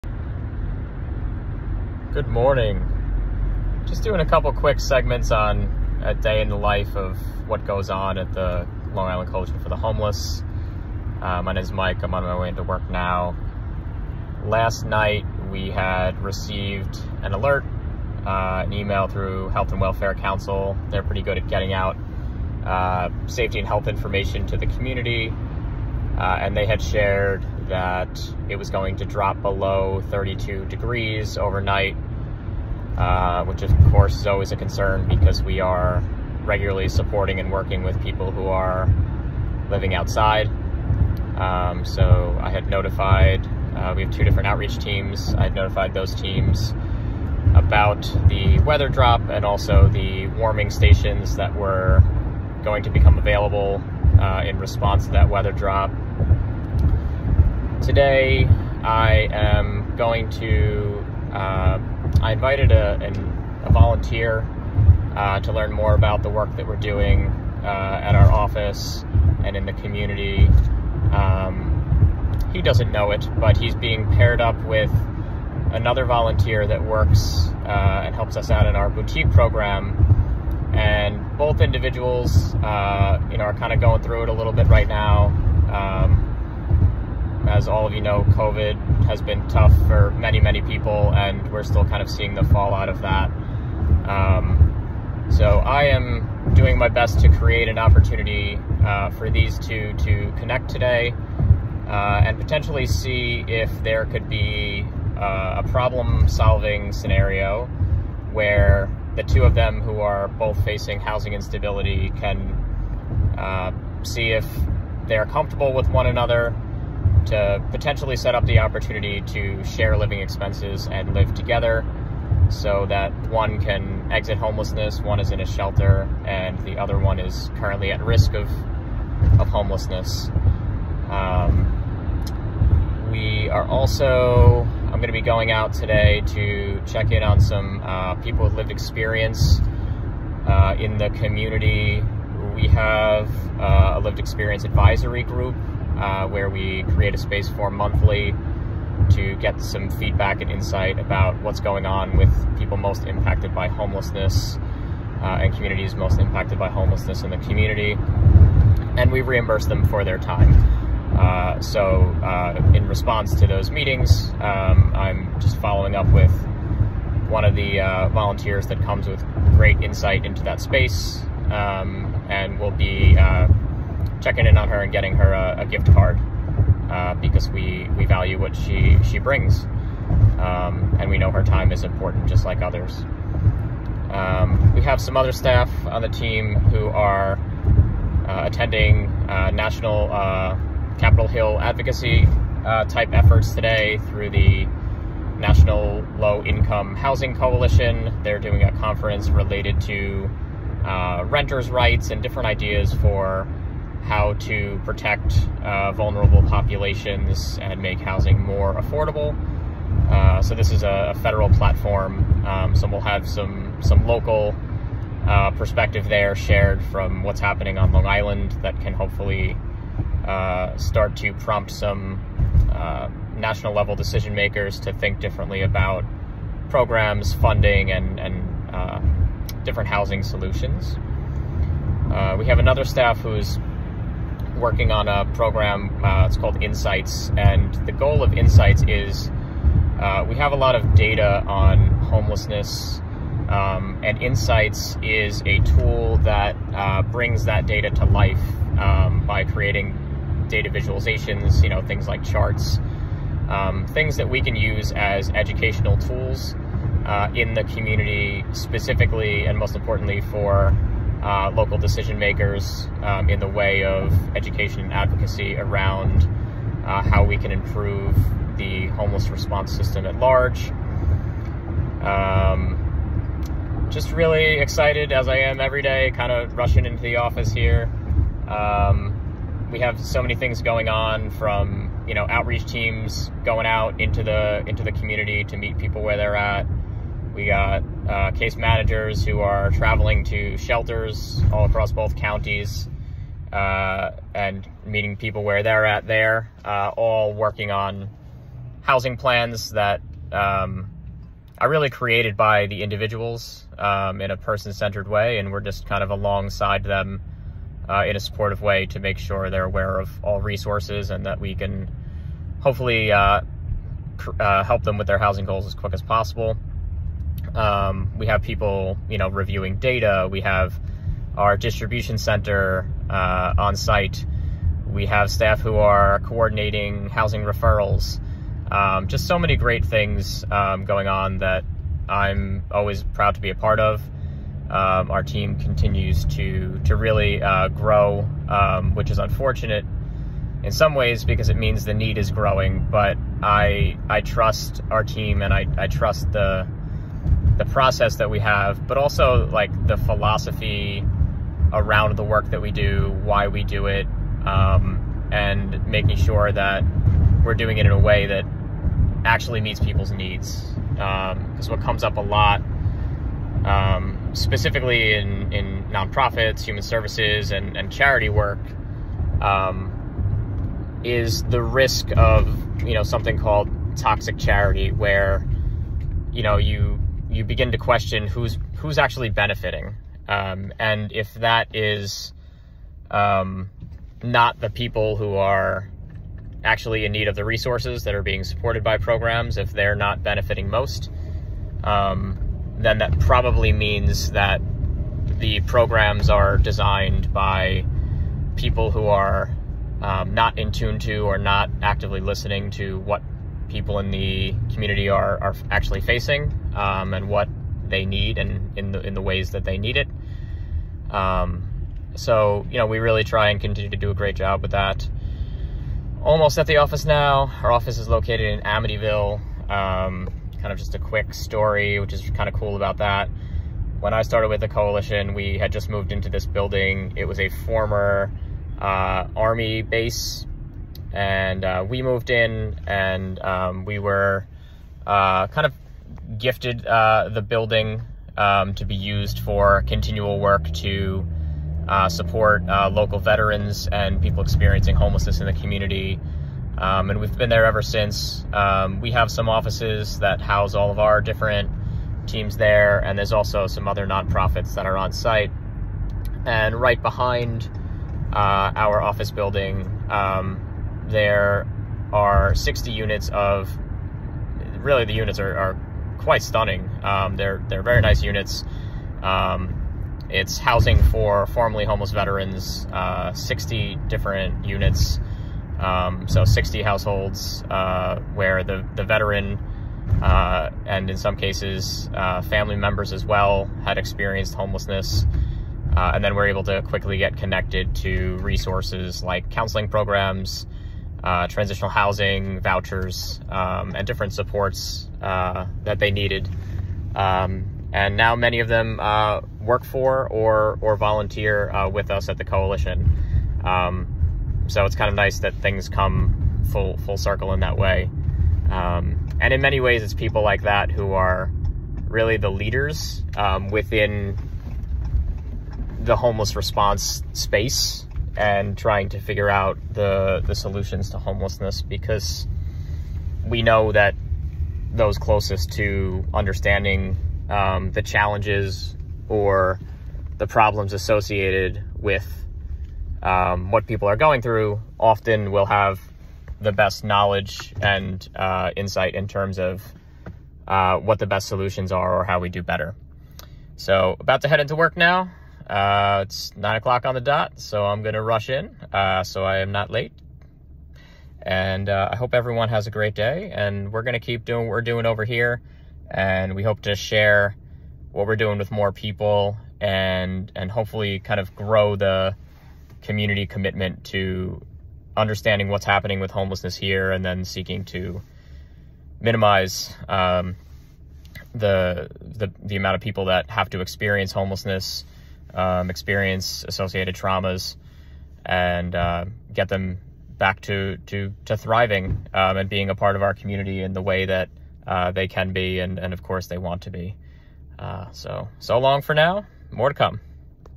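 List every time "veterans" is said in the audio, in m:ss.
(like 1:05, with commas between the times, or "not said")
7:23, 7:52, 7:59.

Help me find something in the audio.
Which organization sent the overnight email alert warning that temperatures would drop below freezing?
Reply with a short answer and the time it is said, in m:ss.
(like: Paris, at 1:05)
Health and Welfare Council, at 0:19.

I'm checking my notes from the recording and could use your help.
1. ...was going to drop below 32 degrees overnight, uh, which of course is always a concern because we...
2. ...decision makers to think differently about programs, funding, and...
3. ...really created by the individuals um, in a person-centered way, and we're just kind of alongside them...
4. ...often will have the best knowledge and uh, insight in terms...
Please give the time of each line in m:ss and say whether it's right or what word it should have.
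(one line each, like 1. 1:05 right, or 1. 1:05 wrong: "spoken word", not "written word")
1. 0:28 right
2. 3:43 right
3. 5:01 right
4. 8:54 right.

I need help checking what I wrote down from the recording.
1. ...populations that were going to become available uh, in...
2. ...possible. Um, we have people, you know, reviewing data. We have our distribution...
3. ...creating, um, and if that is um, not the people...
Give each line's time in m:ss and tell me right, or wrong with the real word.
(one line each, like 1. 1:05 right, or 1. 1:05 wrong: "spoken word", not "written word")
1. 0:50 wrong: "stations", not "populations"
2. 5:16 right
3. 6:19 wrong: "benefiting", not "creating".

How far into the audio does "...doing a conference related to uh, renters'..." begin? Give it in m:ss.
3:18.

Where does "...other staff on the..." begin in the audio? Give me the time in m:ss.
3:05.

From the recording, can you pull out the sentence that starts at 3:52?
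we have another staff who's working on a program.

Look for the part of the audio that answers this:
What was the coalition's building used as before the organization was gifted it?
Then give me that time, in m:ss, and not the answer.
7:09.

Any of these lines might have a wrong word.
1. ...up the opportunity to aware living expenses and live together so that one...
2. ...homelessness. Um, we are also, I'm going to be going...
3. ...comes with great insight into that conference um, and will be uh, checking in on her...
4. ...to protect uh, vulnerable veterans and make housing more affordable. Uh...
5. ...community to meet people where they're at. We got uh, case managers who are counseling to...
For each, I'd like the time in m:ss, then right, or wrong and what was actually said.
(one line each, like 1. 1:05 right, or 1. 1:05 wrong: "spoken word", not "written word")
1. 1:58 wrong: "share", not "aware"
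2. 2:09 right
3. 2:48 wrong: "space", not "conference"
4. 3:24 wrong: "populations", not "veterans"
5. 4:44 wrong: "traveling", not "counseling".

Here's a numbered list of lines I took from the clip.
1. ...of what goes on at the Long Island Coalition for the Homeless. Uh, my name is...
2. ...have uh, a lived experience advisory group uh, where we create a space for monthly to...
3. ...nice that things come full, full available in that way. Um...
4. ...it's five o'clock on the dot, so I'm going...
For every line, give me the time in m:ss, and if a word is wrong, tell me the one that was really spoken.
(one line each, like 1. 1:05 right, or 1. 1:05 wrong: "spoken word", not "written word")
1. 0:06 right
2. 2:22 right
3. 8:25 wrong: "circle", not "available"
4. 9:06 wrong: "nine", not "five".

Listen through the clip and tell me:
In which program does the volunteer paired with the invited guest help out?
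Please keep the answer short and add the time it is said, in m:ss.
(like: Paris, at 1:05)
boutique program, at 1:18.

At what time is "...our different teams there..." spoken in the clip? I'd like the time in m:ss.
7:30.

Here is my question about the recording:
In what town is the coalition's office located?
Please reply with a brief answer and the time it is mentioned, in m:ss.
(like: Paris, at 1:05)
Amityville, at 6:58.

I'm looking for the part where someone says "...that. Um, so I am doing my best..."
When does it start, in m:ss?
1:33.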